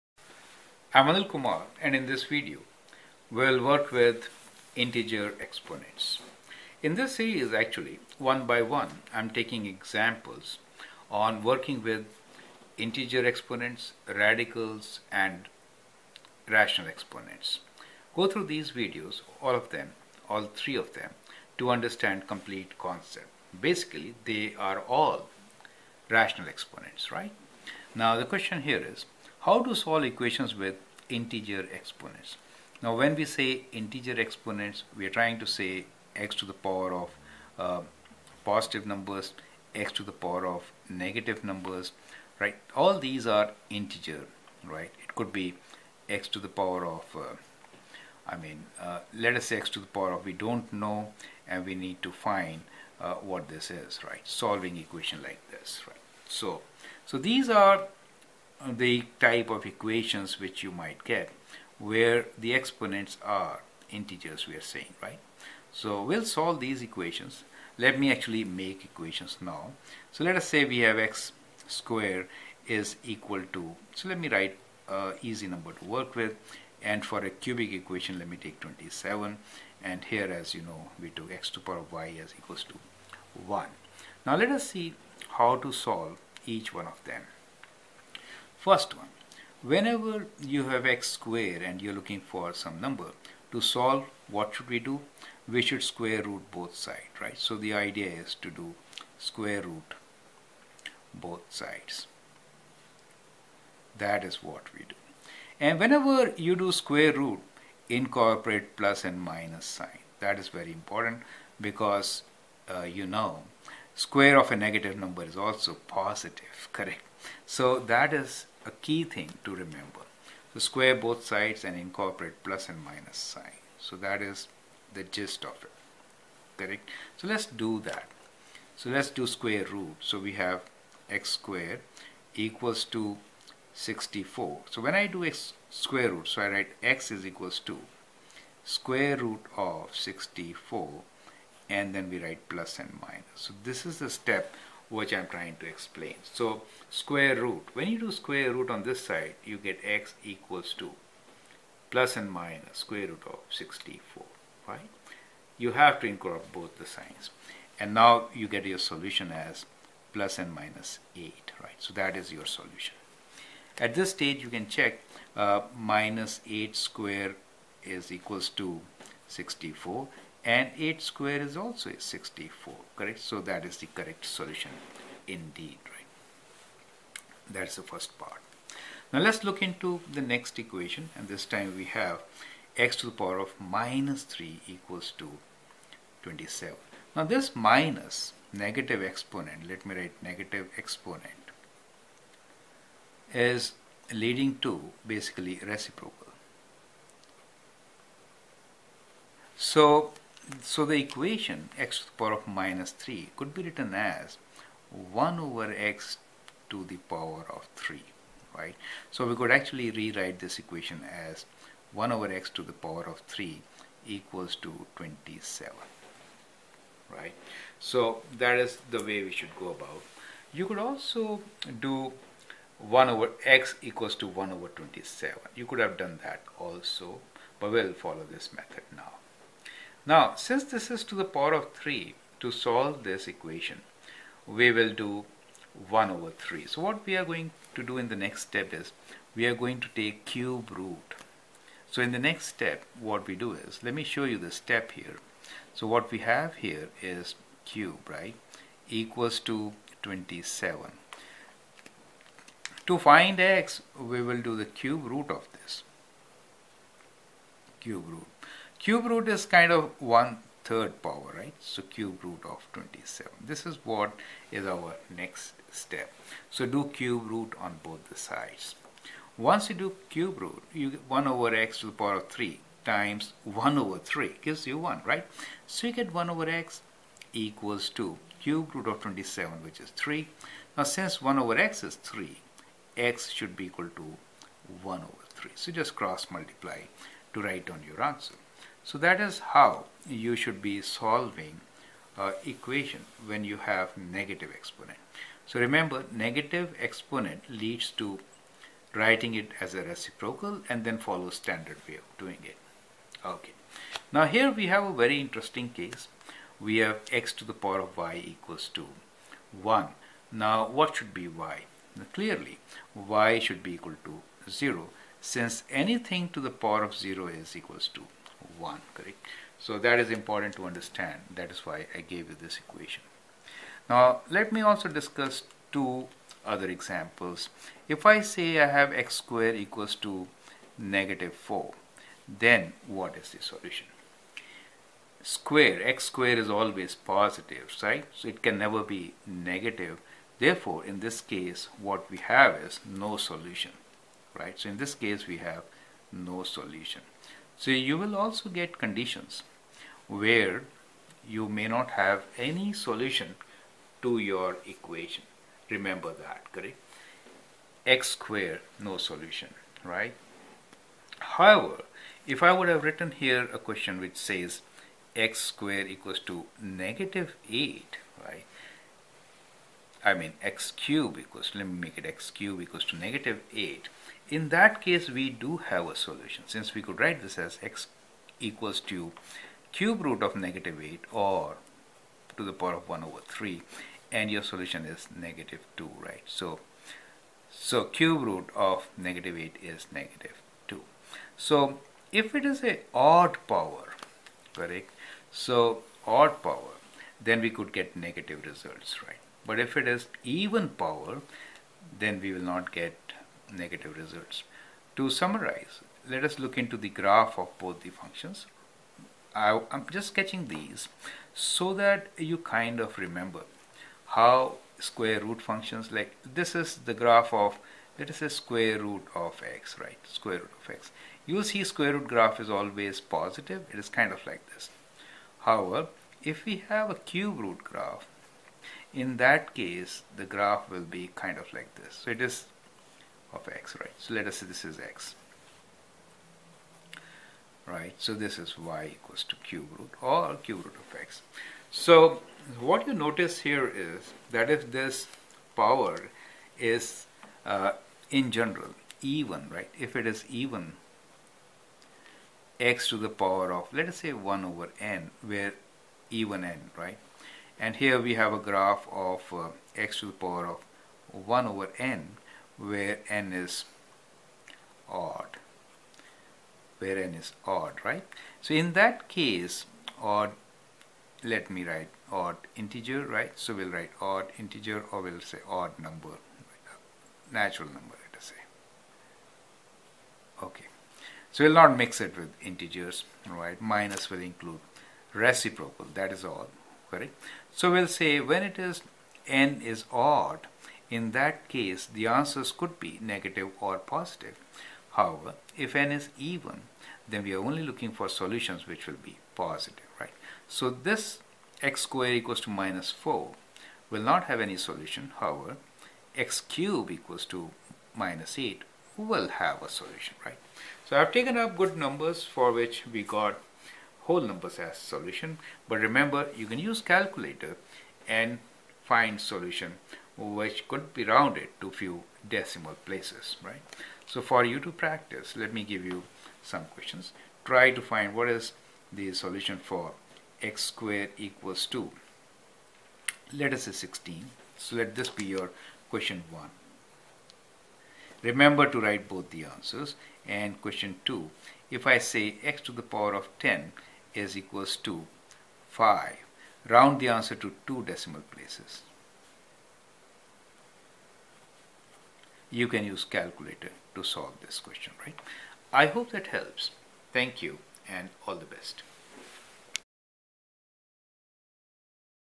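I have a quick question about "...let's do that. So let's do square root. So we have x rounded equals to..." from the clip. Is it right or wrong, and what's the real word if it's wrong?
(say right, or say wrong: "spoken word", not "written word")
wrong: "squared", not "rounded".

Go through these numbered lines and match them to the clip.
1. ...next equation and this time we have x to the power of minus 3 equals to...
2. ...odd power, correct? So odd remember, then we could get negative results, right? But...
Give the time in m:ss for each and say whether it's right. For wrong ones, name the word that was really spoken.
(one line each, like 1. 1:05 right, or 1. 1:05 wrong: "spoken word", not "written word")
1. 3:00 right
2. 6:32 wrong: "power", not "remember".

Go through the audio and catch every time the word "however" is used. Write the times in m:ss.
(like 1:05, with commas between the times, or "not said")
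6:01, 7:05, 8:14, 8:25.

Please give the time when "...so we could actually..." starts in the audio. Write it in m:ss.
3:29.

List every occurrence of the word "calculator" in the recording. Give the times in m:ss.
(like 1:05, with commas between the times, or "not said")
8:36, 9:13.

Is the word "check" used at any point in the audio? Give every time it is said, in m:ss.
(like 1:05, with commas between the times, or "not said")
2:44.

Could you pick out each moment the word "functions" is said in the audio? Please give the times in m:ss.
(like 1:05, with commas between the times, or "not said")
6:47, 6:55.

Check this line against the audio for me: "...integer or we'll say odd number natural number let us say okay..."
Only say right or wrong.
right.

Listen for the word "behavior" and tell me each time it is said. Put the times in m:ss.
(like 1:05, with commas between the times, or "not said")
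not said.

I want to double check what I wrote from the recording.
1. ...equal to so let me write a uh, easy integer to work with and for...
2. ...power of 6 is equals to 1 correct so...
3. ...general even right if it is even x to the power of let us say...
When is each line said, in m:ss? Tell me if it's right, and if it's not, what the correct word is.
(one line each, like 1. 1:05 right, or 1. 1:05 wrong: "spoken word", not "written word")
1. 1:13 wrong: "number", not "integer"
2. 5:16 wrong: "0", not "6"
3. 7:28 right.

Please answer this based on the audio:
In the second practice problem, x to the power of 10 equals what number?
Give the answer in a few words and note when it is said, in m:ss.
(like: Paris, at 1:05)
5, at 9:05.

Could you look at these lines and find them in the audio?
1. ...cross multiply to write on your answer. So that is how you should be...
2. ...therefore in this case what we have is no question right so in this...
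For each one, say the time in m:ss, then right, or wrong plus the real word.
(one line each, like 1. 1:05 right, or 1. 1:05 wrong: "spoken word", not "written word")
1. 4:45 right
2. 5:40 wrong: "solution", not "question".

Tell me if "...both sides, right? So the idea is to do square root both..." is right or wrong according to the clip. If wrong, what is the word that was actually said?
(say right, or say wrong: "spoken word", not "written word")
right.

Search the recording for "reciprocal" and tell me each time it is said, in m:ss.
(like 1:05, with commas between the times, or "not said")
3:15, 4:59, 8:05.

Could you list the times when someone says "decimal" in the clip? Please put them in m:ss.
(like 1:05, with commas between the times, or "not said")
8:42, 9:07.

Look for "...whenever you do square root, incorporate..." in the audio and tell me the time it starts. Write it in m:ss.
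1:45.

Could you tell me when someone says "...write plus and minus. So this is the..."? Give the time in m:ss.
2:22.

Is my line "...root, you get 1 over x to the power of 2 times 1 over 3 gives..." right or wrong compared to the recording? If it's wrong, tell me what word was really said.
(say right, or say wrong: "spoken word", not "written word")
wrong: "3", not "2".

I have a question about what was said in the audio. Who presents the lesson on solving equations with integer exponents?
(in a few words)
Anil Kumar.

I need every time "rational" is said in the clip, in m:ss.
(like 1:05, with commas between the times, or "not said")
0:16, 0:26.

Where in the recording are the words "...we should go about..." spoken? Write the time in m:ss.
3:39.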